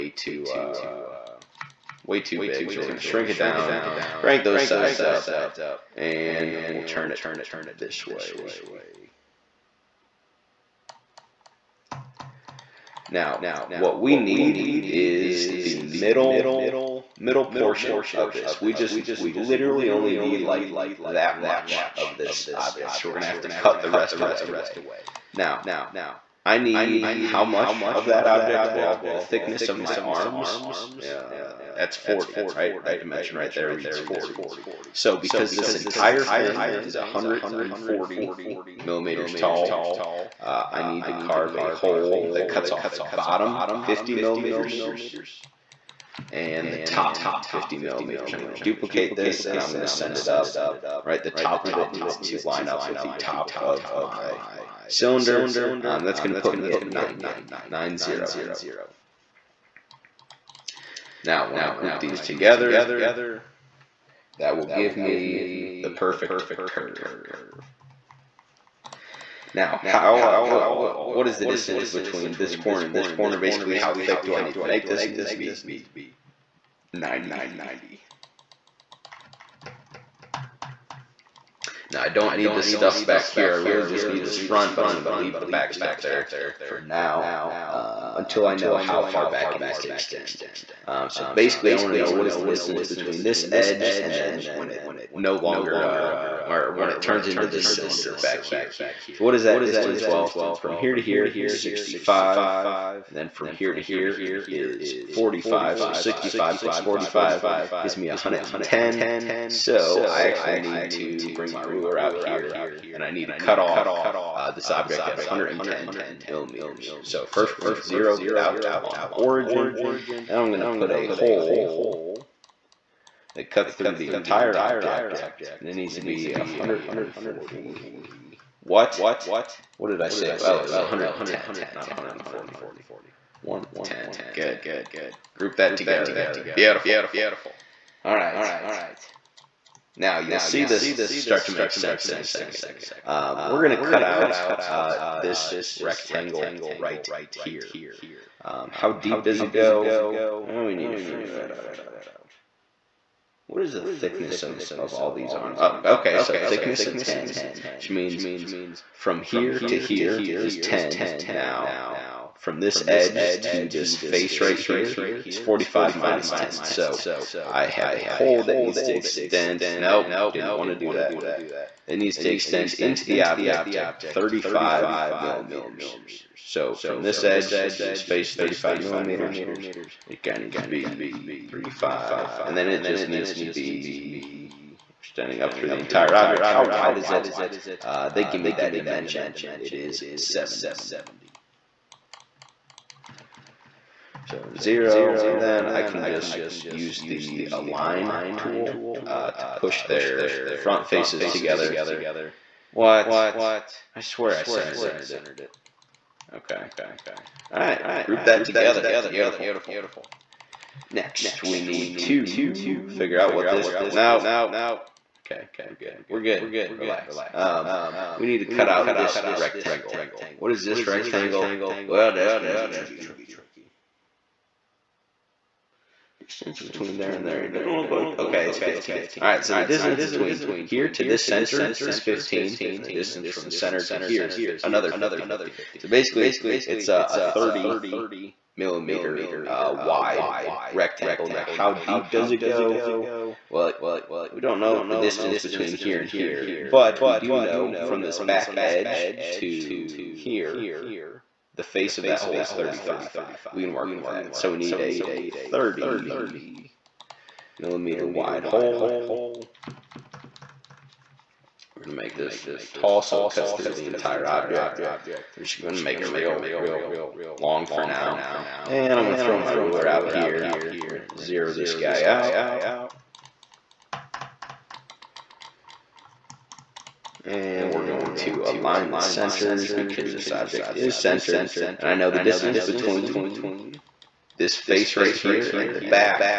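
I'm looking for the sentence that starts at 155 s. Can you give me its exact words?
Oh, okay, so thickness of 10, which means from here to here is 10.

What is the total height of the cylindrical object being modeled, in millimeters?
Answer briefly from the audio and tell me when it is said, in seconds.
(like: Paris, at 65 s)
140, at 36 s.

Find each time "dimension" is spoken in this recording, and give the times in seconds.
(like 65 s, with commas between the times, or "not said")
32 s, 188 s.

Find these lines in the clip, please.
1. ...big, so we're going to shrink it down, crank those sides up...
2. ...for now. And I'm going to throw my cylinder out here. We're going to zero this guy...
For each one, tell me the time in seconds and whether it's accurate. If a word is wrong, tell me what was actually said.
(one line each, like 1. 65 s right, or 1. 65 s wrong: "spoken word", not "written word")
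1. 2 s right
2. 267 s wrong: "ruler", not "cylinder".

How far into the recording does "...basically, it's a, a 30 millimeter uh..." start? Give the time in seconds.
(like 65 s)
235 s.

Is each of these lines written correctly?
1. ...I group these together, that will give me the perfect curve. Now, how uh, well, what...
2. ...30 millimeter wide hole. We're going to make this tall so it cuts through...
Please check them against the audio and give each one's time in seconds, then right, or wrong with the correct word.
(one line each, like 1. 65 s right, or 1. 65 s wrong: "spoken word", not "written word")
1. 61 s right
2. 255 s right.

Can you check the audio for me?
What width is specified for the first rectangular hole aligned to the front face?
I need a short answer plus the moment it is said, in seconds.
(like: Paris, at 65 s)
70, at 189 s.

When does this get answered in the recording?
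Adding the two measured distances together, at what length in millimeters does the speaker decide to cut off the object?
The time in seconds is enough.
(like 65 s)
105 s.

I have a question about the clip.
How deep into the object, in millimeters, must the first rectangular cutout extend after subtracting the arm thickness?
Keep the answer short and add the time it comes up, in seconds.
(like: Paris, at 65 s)
35, at 172 s.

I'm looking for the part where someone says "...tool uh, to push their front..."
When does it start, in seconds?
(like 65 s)
198 s.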